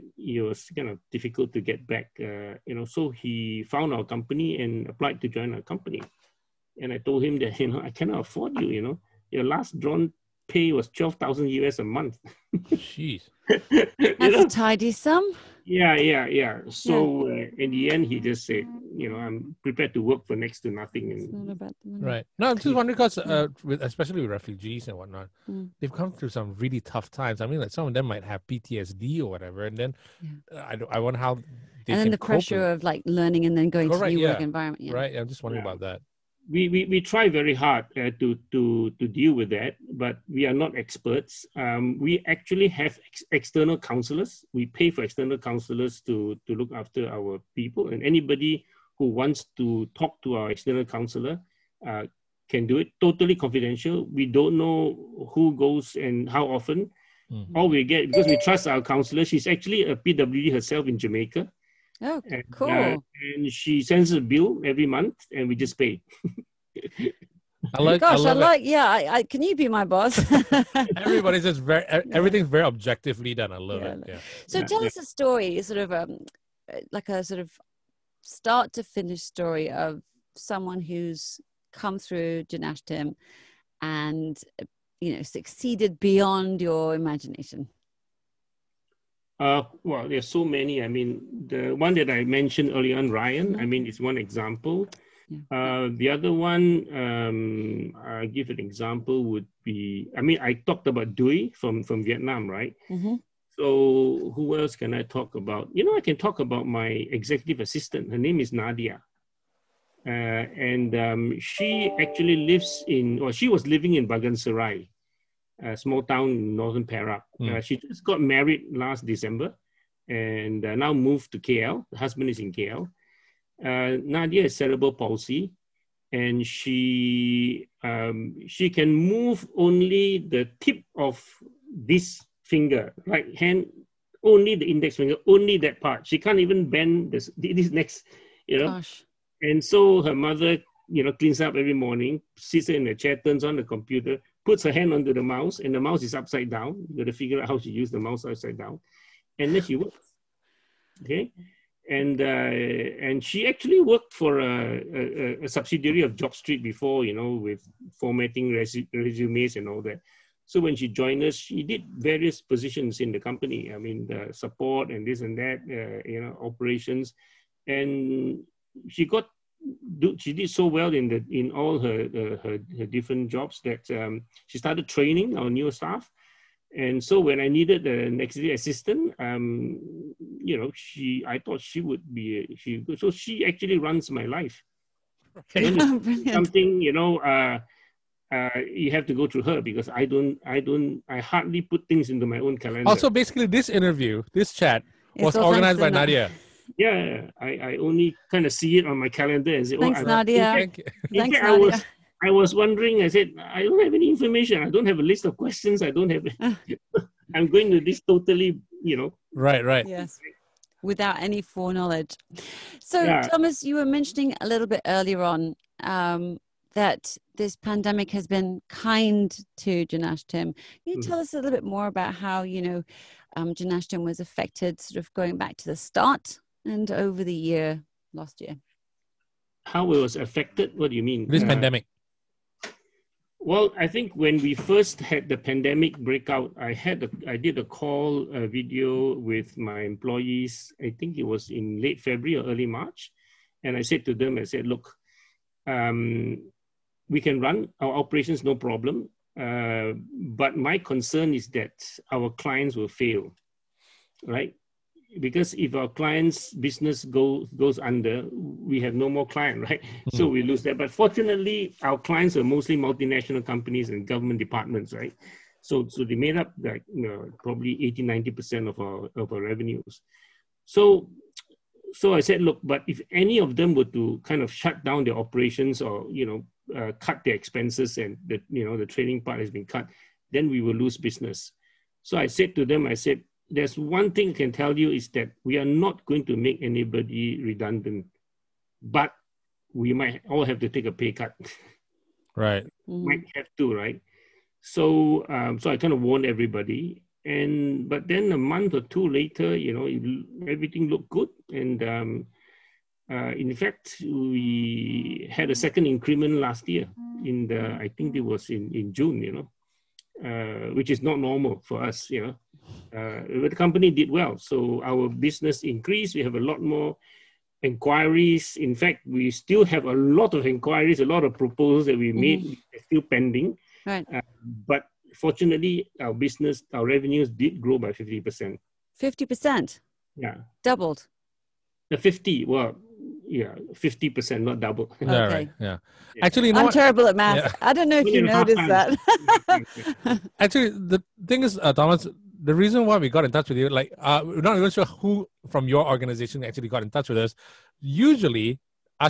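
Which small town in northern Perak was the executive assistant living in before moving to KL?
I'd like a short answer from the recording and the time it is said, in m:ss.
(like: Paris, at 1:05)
Bagan Serai, at 1:54.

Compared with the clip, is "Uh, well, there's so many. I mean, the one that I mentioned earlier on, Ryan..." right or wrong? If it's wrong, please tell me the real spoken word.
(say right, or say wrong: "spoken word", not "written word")
right.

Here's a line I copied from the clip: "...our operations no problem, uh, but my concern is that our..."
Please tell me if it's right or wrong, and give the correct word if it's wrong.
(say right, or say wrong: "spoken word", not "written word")
right.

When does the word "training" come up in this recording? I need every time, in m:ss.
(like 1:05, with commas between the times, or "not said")
2:54, 4:38.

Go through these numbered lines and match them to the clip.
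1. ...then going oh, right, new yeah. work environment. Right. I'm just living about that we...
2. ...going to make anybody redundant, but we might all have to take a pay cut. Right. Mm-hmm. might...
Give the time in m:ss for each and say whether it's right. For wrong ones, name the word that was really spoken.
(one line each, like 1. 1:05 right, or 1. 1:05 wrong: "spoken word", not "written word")
1. 0:33 wrong: "wondering", not "living"
2. 4:46 right.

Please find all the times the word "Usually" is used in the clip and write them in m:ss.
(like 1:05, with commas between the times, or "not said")
5:47.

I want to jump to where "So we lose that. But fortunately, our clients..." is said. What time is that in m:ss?
4:20.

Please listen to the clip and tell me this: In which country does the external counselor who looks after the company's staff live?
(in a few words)
Jamaica.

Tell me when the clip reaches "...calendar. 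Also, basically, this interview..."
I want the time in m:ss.
3:12.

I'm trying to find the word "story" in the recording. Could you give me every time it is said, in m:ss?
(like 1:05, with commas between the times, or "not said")
1:15, 1:19.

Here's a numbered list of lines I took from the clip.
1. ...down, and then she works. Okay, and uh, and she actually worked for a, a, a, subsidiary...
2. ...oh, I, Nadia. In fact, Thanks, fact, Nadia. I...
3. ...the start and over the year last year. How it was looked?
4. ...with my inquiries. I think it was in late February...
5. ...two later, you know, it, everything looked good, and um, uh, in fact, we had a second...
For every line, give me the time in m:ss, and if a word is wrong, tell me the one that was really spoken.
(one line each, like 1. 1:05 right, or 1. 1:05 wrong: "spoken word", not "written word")
1. 2:28 right
2. 3:19 right
3. 3:45 wrong: "affected", not "looked"
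4. 3:59 wrong: "employees", not "inquiries"
5. 4:58 right.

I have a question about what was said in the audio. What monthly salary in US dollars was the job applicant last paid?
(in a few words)
12,000 US.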